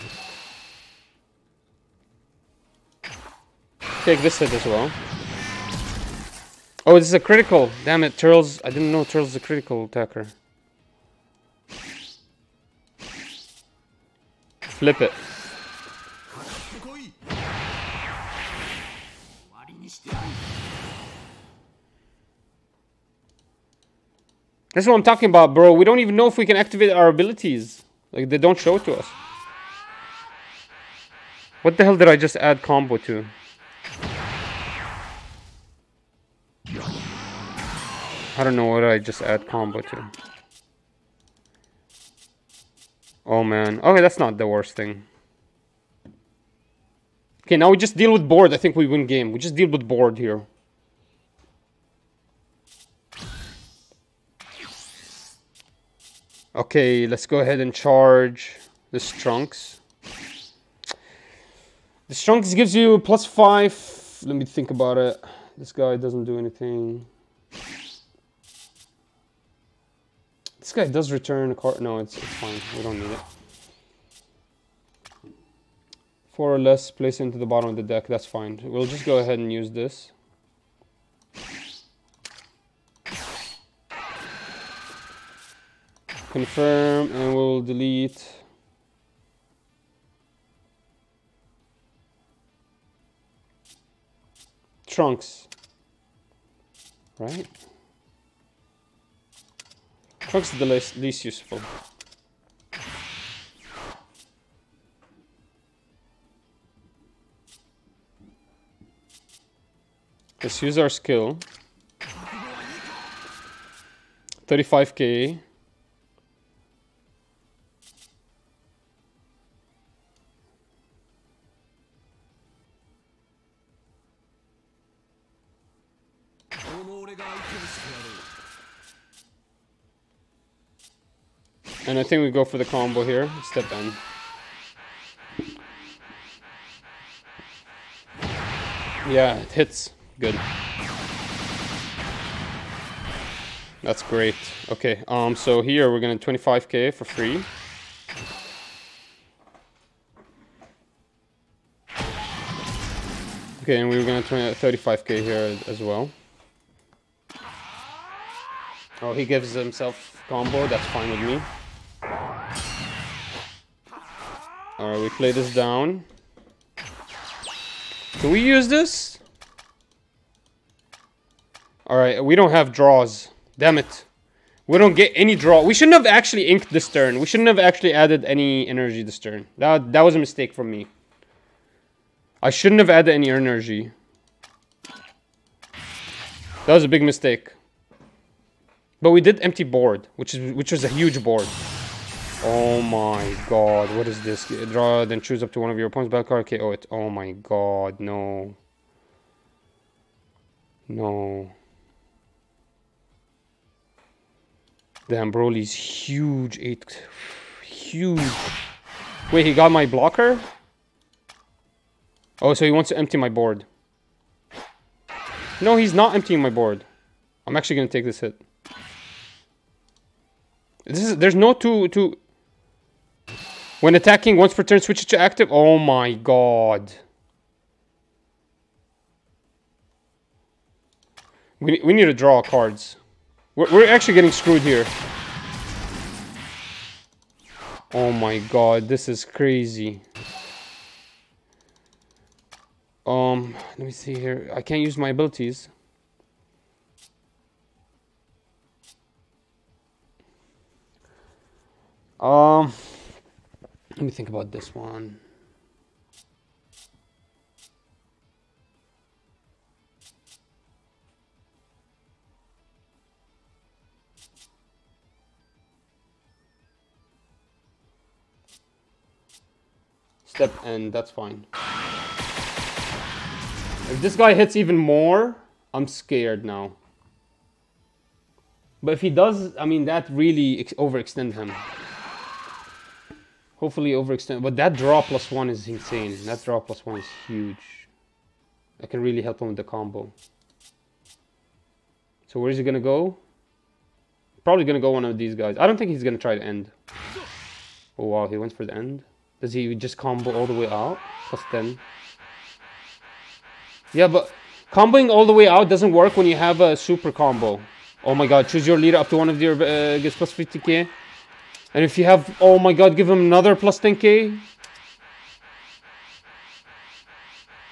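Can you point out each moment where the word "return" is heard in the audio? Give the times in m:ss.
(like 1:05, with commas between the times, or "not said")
1:11.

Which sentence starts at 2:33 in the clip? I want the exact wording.
Okay, and we gonna gonna 20, 35k here as well.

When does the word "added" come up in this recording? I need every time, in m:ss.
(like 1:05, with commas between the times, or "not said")
2:57, 3:02.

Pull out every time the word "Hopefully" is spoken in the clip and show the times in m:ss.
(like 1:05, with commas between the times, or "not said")
4:43.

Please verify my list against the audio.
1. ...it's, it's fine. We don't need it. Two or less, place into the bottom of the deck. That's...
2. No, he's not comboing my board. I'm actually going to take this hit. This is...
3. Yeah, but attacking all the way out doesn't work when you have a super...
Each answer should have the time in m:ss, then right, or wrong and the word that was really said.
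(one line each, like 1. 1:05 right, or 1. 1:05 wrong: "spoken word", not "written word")
1. 1:11 wrong: "Four", not "Two"
2. 3:35 wrong: "emptying", not "comboing"
3. 5:03 wrong: "comboing", not "attacking".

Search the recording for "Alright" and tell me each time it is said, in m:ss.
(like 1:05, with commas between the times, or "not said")
2:44, 2:51.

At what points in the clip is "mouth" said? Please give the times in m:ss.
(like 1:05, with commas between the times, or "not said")
not said.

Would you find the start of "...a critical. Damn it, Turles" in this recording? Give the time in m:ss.
0:07.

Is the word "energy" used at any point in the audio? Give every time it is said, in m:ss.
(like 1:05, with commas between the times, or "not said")
2:58, 3:03.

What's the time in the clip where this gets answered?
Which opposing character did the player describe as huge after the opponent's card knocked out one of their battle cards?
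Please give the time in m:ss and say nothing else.
3:25.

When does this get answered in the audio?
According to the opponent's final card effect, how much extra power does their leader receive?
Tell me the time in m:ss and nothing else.
5:10.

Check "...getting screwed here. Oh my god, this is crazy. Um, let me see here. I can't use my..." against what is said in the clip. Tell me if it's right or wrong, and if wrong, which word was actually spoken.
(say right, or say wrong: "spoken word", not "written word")
right.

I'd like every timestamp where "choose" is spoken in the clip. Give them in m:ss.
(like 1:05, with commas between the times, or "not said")
3:15, 5:08.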